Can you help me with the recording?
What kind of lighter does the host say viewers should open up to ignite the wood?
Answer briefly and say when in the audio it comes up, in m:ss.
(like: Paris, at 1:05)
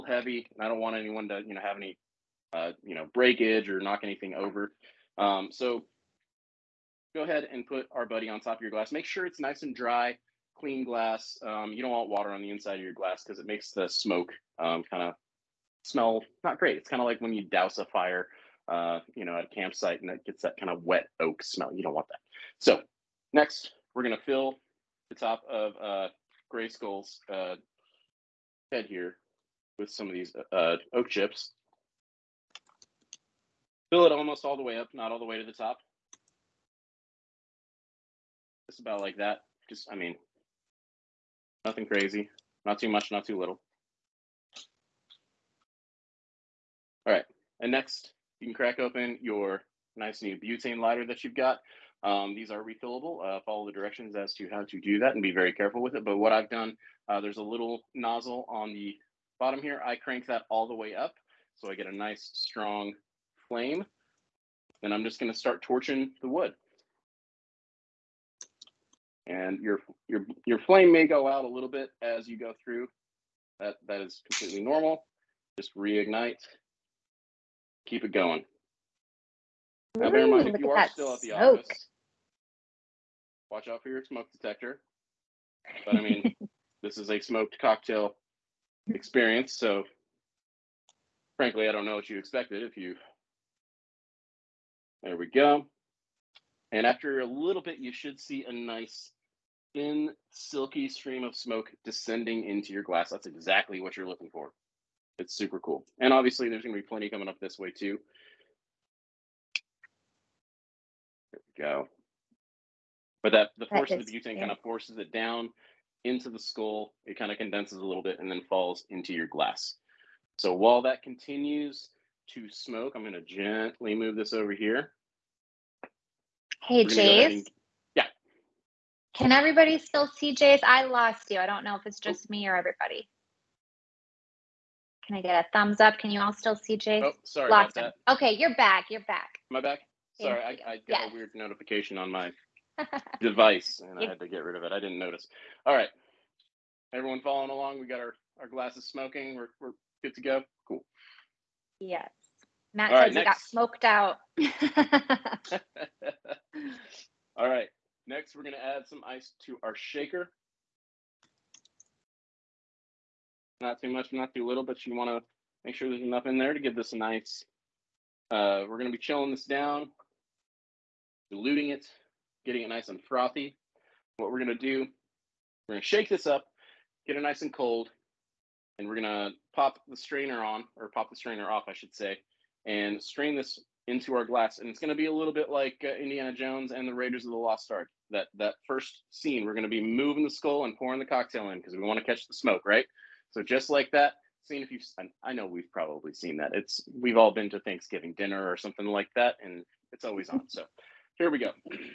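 Butane lighter, at 0:50.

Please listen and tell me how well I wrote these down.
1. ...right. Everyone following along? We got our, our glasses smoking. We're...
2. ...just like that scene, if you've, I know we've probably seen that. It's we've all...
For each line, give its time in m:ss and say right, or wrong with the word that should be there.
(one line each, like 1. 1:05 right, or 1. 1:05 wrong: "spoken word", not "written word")
1. 2:25 right
2. 3:13 right.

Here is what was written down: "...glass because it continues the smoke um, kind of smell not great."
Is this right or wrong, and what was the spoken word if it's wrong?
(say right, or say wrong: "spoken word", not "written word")
wrong: "makes", not "continues".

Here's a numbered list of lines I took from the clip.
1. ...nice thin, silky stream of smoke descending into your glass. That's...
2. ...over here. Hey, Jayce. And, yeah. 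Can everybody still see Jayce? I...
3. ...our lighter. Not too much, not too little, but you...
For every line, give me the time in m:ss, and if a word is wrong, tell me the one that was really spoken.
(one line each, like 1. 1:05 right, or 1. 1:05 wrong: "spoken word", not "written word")
1. 1:38 right
2. 2:04 right
3. 2:39 wrong: "shaker", not "lighter".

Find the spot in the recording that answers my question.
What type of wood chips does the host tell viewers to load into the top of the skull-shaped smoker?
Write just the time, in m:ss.
0:30.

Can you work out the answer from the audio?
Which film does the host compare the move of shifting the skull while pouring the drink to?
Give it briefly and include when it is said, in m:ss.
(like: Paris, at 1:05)
Raiders of the Lost Ark, at 3:06.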